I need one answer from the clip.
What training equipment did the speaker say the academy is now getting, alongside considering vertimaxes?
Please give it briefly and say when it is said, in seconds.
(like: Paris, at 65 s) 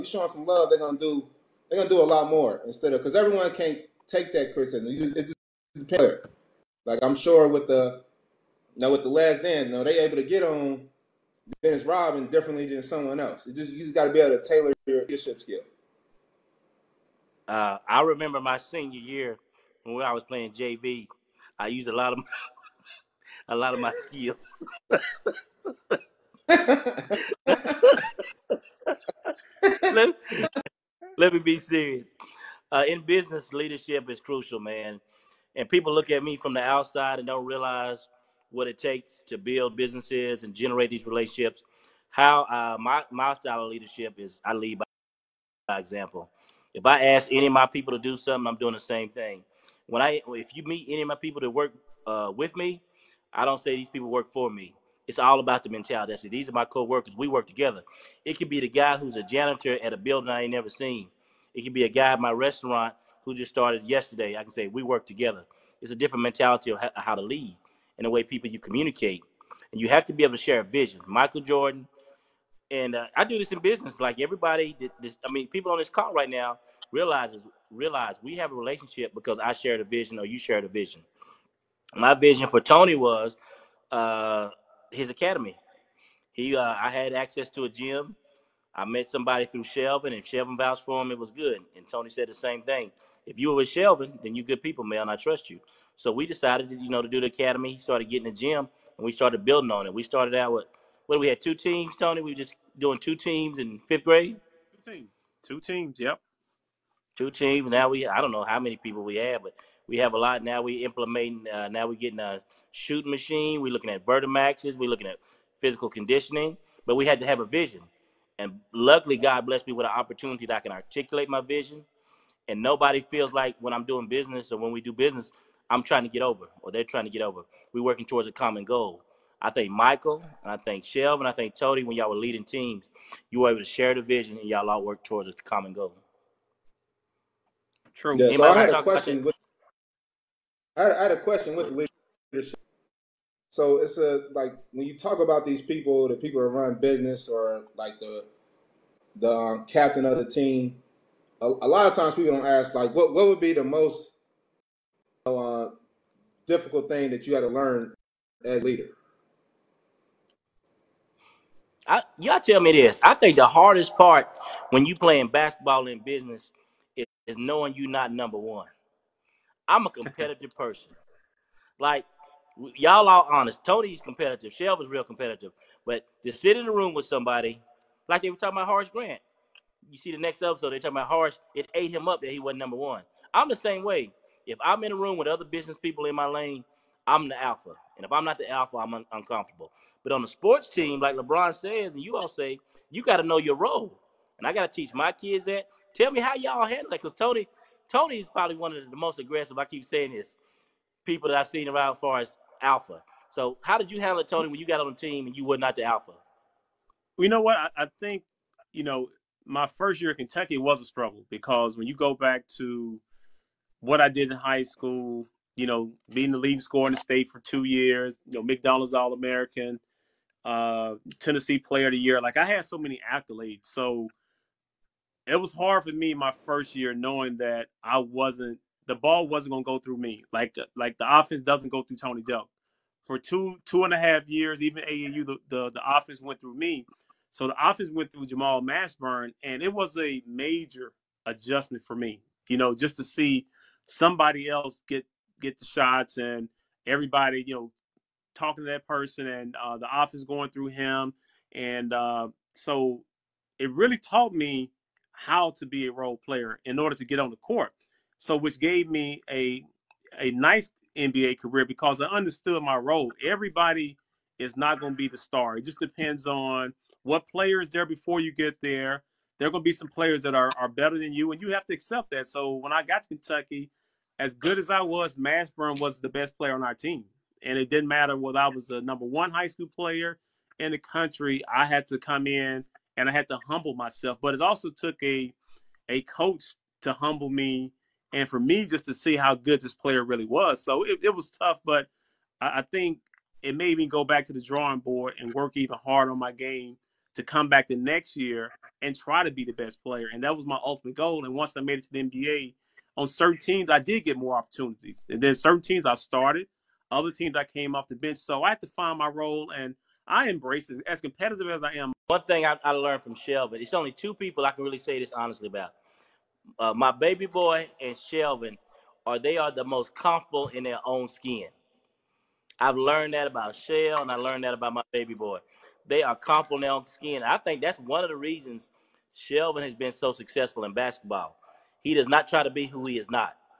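shooting machine, at 112 s.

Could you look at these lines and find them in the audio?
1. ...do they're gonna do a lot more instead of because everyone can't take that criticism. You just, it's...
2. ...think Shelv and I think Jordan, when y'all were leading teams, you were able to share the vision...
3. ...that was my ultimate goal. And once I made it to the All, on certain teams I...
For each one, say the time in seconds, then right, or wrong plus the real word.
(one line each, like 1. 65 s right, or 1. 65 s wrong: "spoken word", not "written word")
1. 0 s right
2. 130 s wrong: "Tony", not "Jordan"
3. 300 s wrong: "NBA", not "All".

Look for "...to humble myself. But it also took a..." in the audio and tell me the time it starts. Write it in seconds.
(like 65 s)
283 s.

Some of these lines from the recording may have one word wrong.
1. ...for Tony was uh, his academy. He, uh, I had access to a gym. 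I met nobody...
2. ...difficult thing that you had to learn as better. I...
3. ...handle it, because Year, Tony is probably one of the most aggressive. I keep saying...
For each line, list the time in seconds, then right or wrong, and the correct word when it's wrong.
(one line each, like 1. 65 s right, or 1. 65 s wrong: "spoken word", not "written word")
1. 82 s wrong: "somebody", not "nobody"
2. 156 s wrong: "leader", not "better"
3. 196 s wrong: "Tony", not "Year".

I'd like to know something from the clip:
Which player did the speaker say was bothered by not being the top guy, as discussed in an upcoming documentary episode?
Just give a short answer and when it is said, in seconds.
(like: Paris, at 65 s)
Horace Grant, at 178 s.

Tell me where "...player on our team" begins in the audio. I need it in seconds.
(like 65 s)
276 s.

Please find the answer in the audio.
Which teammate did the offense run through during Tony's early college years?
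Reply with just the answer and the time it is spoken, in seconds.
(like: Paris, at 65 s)
Jamal Mashburn, at 238 s.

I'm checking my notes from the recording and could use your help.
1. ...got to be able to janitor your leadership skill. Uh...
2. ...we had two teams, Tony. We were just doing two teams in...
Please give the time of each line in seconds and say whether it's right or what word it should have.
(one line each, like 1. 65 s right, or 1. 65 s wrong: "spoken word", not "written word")
1. 13 s wrong: "tailor", not "janitor"
2. 101 s right.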